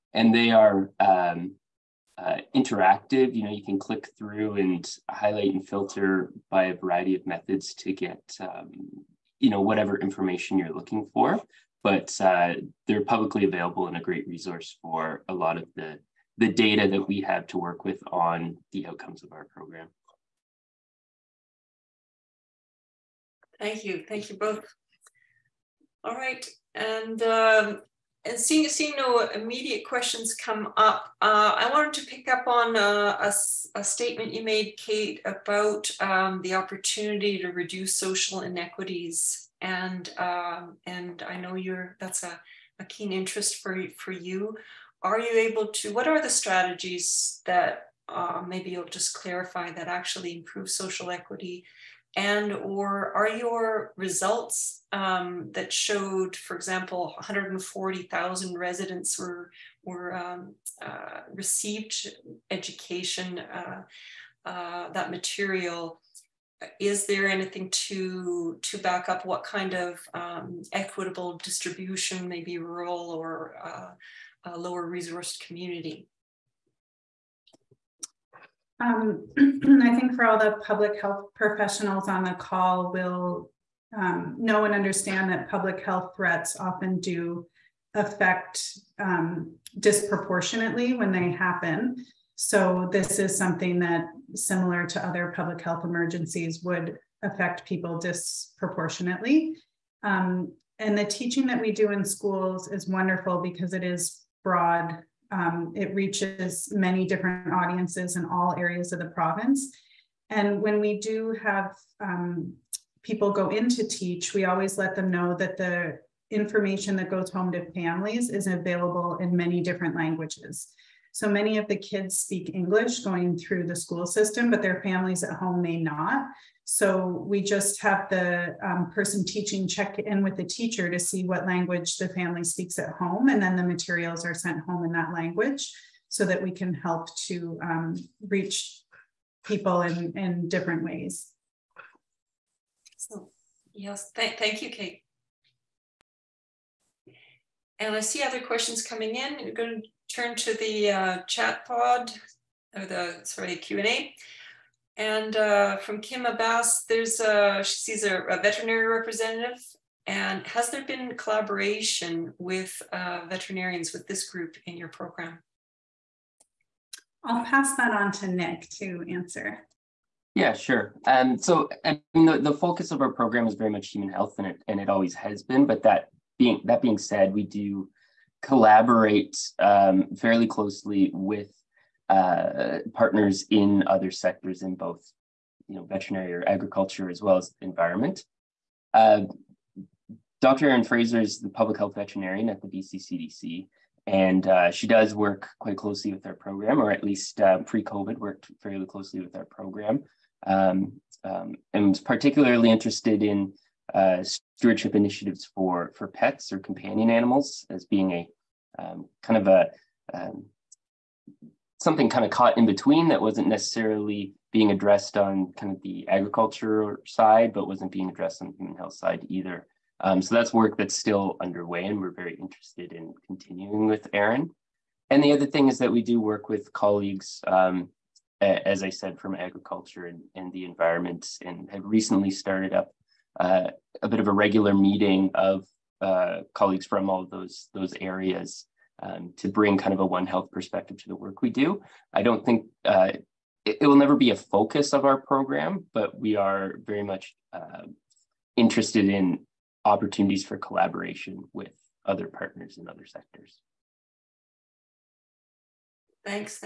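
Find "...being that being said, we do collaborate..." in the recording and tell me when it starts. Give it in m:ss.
2:56.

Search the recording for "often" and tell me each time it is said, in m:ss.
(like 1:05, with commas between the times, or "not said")
1:26.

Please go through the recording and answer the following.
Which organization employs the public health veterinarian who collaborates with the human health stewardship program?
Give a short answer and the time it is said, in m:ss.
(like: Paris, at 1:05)
BC CDC, at 3:12.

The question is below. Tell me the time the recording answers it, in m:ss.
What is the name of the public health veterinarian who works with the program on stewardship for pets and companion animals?
3:10.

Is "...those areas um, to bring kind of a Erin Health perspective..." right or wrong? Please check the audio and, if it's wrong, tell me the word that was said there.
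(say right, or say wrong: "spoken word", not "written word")
wrong: "One", not "Erin".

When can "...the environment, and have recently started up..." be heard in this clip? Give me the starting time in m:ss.
3:50.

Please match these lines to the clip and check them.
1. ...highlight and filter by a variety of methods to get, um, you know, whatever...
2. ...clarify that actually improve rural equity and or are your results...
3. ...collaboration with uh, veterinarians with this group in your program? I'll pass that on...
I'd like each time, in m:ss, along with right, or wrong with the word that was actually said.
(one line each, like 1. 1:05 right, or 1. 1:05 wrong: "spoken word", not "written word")
1. 0:05 right
2. 0:49 wrong: "social", not "rural"
3. 2:41 right.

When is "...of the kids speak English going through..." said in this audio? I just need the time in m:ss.
2:01.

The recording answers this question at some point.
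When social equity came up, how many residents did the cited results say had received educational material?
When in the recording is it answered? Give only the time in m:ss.
0:57.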